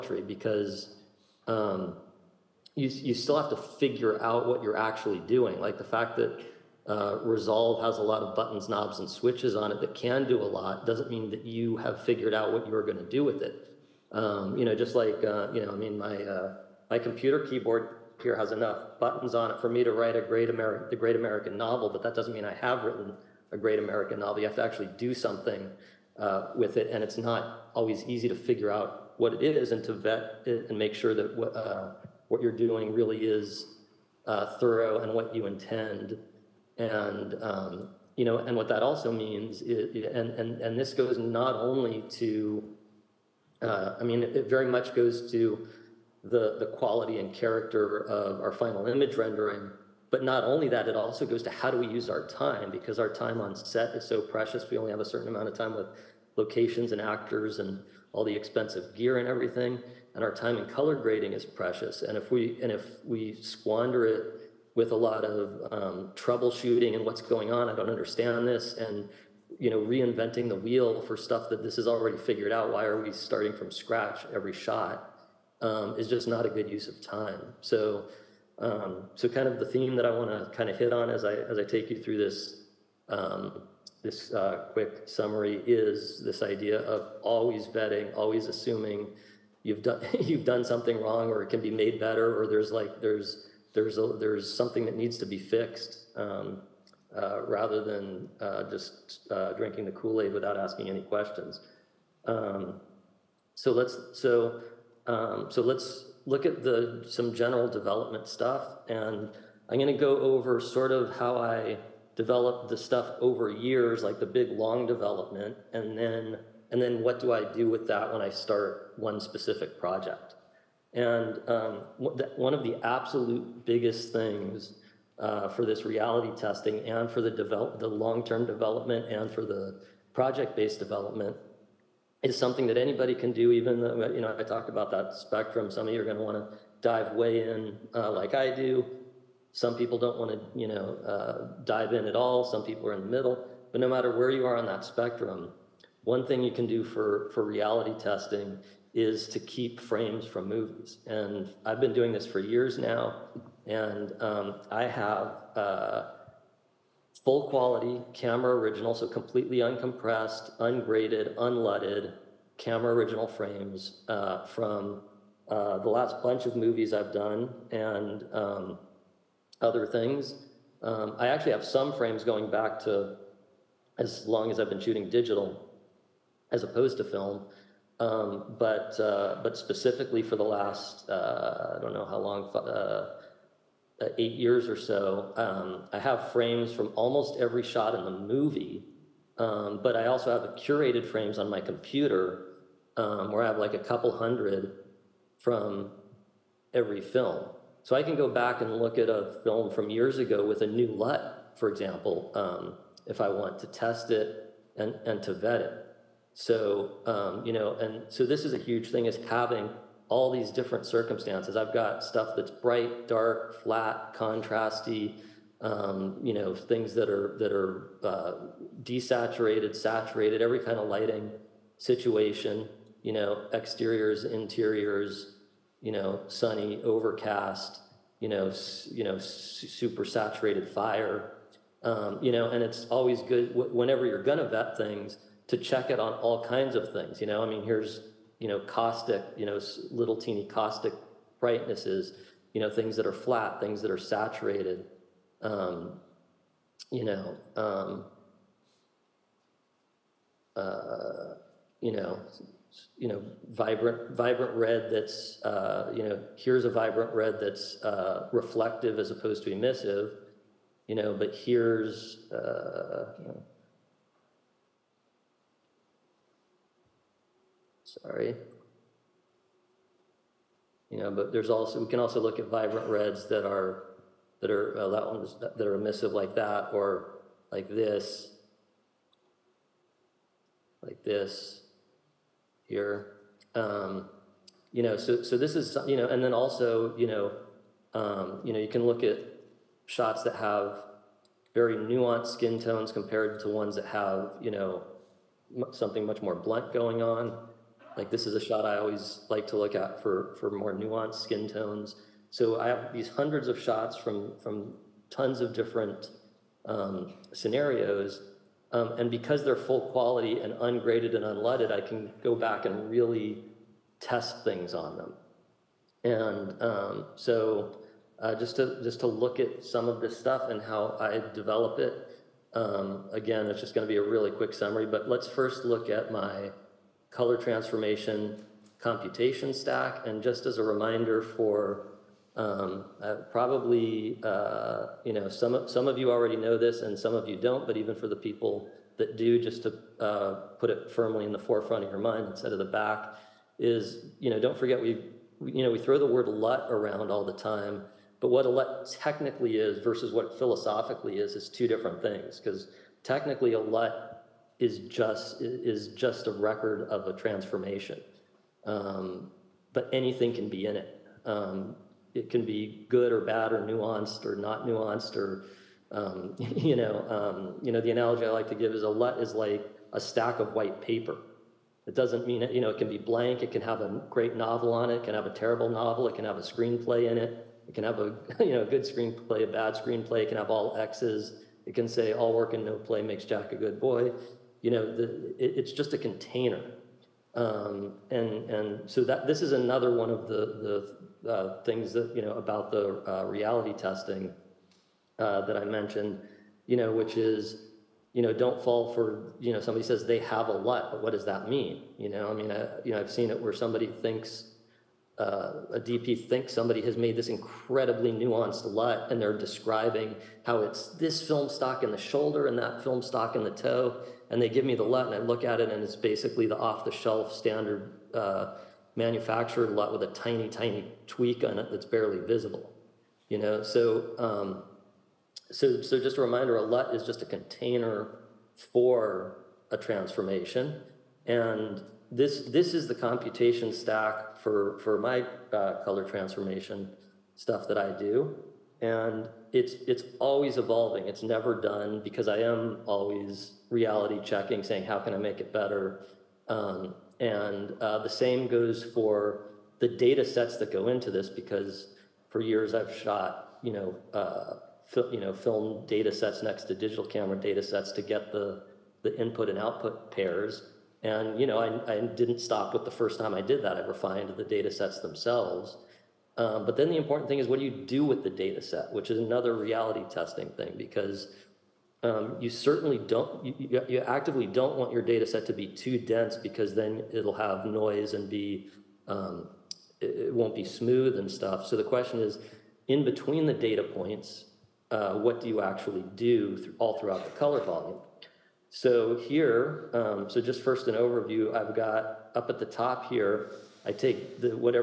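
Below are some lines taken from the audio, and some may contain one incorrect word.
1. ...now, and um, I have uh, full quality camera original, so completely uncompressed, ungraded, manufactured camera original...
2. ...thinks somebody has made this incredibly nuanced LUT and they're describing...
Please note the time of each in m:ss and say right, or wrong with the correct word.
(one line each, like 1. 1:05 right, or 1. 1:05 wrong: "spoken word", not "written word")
1. 2:32 wrong: "unleaded", not "manufactured"
2. 6:46 right.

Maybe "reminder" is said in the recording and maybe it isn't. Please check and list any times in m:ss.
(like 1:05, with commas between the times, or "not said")
5:30, 7:06.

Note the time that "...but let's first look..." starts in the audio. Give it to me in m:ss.
5:24.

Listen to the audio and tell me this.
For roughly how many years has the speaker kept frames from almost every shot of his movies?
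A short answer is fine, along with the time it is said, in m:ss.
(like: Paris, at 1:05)
8, at 3:04.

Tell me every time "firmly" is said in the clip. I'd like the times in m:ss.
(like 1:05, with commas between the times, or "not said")
5:40.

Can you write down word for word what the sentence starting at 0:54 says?
We only have a certain amount of time with locations and actors and all the expensive gear and everything.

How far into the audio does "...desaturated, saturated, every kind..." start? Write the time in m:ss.
3:38.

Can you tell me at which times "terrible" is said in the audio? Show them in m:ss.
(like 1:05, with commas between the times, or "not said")
6:15.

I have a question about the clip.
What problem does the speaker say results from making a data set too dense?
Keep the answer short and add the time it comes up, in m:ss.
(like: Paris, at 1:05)
Noise, at 7:57.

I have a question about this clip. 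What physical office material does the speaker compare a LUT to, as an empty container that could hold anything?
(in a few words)
A stack of white paper.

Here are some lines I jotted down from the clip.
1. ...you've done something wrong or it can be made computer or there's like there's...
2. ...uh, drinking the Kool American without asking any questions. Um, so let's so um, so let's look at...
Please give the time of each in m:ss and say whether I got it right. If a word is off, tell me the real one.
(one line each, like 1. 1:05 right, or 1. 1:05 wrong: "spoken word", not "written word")
1. 1:30 wrong: "better", not "computer"
2. 1:39 wrong: "Aid", not "American".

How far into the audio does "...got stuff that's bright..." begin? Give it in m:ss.
3:31.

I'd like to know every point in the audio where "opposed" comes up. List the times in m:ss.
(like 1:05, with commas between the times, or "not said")
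2:56, 4:19.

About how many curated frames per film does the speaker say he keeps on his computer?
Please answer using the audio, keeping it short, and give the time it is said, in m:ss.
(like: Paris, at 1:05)
A couple hundred, at 3:13.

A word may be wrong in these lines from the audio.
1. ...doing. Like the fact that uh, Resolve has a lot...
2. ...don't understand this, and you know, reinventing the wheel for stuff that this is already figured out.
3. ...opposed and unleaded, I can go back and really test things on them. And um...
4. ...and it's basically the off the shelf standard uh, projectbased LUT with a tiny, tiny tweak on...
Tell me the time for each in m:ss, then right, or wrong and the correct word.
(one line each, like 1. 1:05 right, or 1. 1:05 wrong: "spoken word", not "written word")
1. 0:05 right
2. 1:07 right
3. 5:10 wrong: "ungraded", not "opposed"
4. 6:55 wrong: "manufactured", not "projectbased".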